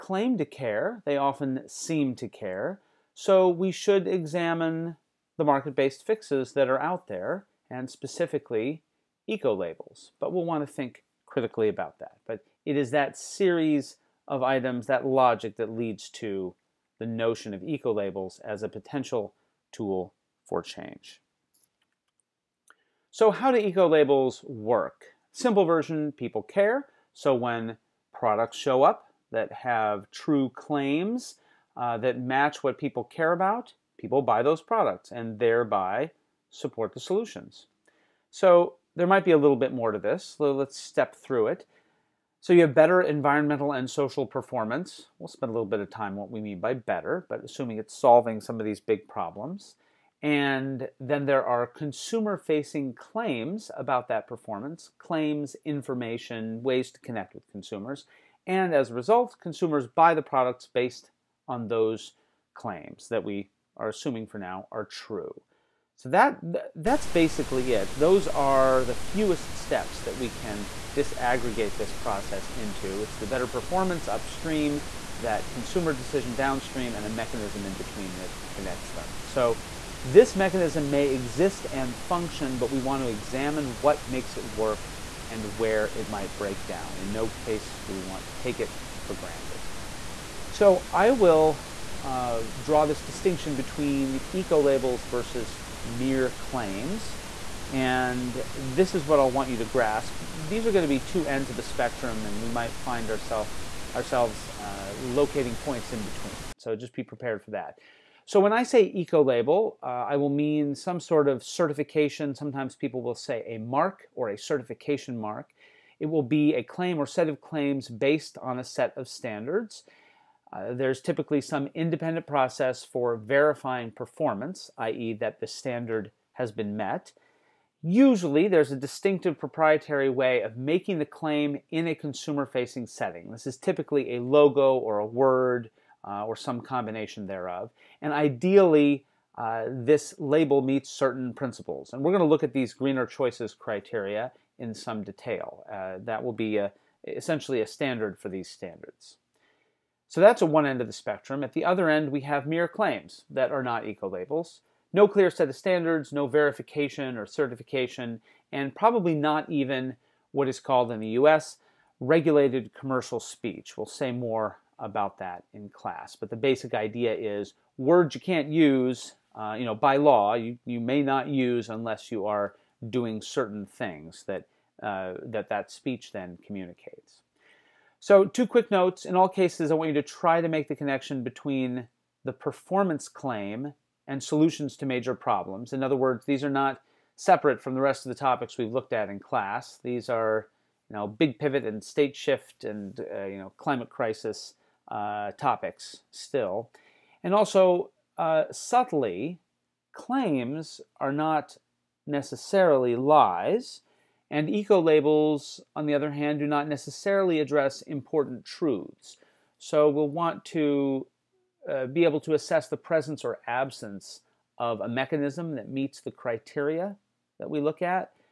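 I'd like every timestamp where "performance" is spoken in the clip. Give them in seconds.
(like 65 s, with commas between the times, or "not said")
44 s, 54 s, 73 s, 123 s, 182 s.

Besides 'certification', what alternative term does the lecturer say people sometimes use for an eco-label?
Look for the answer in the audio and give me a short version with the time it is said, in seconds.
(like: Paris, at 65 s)
Certification mark, at 114 s.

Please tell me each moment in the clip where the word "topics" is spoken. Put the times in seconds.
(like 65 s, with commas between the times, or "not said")
188 s, 195 s.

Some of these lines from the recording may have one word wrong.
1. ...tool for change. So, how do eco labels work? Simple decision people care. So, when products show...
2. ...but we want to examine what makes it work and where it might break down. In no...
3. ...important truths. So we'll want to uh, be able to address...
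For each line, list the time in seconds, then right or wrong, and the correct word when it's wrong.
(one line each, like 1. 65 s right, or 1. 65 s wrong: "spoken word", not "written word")
1. 19 s wrong: "version", not "decision"
2. 82 s right
3. 207 s wrong: "assess", not "address".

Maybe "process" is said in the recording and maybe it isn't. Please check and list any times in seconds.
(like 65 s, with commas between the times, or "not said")
71 s, 122 s.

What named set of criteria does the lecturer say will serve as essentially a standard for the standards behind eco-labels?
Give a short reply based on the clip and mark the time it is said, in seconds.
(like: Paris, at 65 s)
Greener choices criteria, at 142 s.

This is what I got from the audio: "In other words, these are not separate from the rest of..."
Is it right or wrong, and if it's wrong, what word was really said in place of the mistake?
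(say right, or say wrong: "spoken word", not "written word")
right.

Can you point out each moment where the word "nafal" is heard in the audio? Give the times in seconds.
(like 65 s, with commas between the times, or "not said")
not said.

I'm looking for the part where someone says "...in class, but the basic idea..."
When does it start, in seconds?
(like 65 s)
165 s.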